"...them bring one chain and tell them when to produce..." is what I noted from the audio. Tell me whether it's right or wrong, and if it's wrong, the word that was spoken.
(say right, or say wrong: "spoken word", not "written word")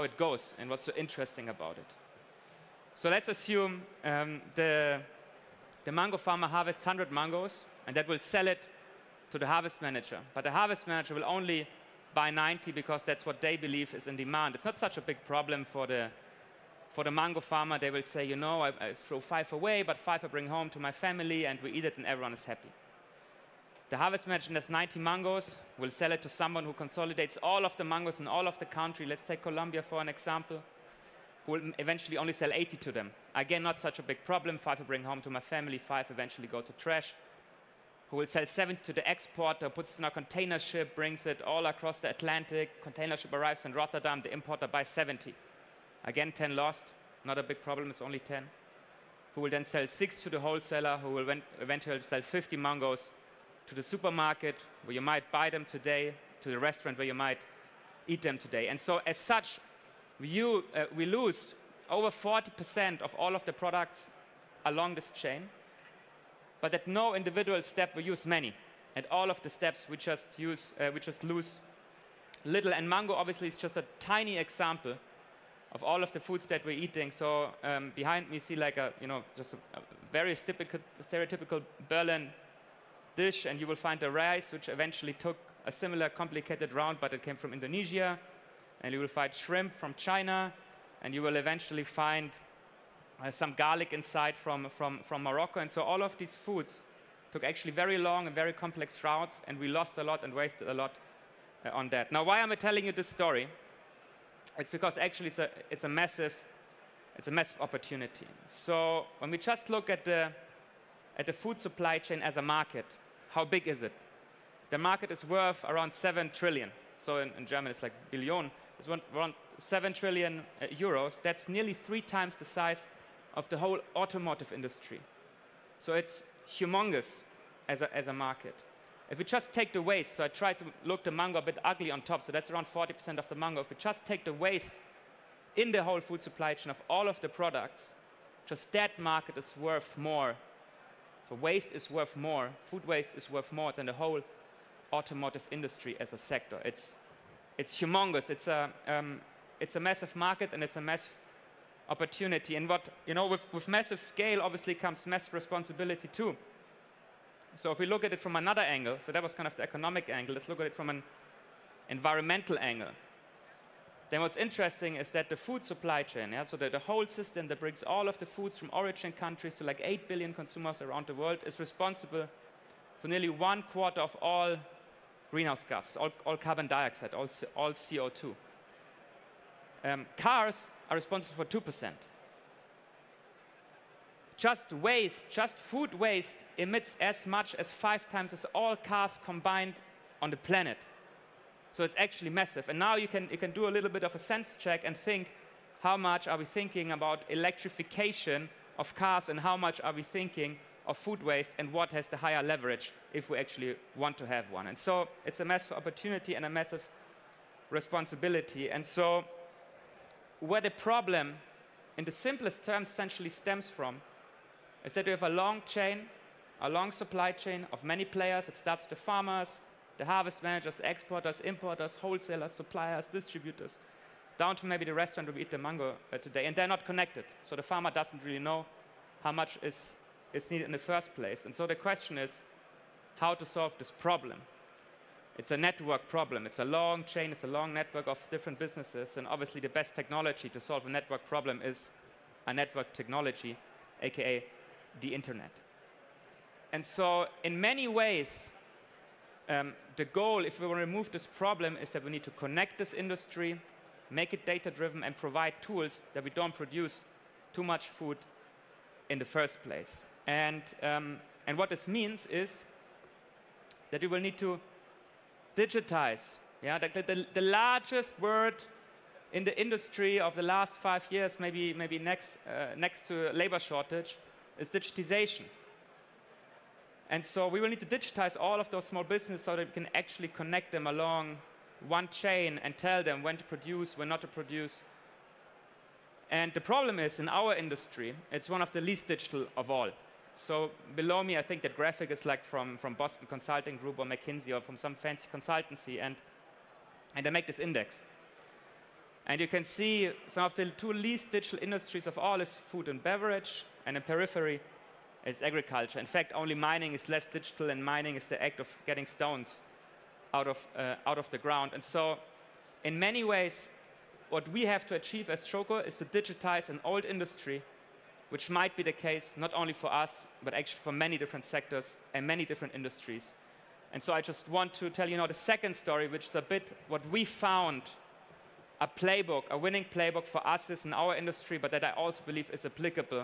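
wrong: "along", not "bring".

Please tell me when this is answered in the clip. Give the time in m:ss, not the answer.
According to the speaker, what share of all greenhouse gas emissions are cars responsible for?
3:01.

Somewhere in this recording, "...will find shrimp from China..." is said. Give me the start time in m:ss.
1:28.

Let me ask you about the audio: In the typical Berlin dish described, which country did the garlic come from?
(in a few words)
Morocco.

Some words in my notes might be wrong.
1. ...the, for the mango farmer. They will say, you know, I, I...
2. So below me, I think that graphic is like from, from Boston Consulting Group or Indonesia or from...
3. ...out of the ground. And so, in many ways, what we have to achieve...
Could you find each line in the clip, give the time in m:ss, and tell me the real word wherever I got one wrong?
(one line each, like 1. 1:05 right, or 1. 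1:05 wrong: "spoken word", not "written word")
1. 0:15 right
2. 4:50 wrong: "McKinsey", not "Indonesia"
3. 5:11 right.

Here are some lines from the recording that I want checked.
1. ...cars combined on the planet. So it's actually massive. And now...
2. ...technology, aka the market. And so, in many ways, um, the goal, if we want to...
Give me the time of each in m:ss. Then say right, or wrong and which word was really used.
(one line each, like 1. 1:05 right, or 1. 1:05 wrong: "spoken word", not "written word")
1. 3:08 right
2. 4:02 wrong: "internet", not "market".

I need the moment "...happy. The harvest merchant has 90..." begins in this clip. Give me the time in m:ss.
0:22.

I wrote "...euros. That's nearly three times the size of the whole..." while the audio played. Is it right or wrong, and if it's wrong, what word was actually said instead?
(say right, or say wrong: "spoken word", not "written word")
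right.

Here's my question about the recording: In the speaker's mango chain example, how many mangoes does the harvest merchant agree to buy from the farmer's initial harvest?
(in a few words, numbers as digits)
90.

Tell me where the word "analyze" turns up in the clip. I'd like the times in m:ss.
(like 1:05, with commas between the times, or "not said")
not said.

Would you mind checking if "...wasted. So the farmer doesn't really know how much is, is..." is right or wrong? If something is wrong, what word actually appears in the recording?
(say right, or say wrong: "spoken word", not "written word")
wrong: "connected", not "wasted".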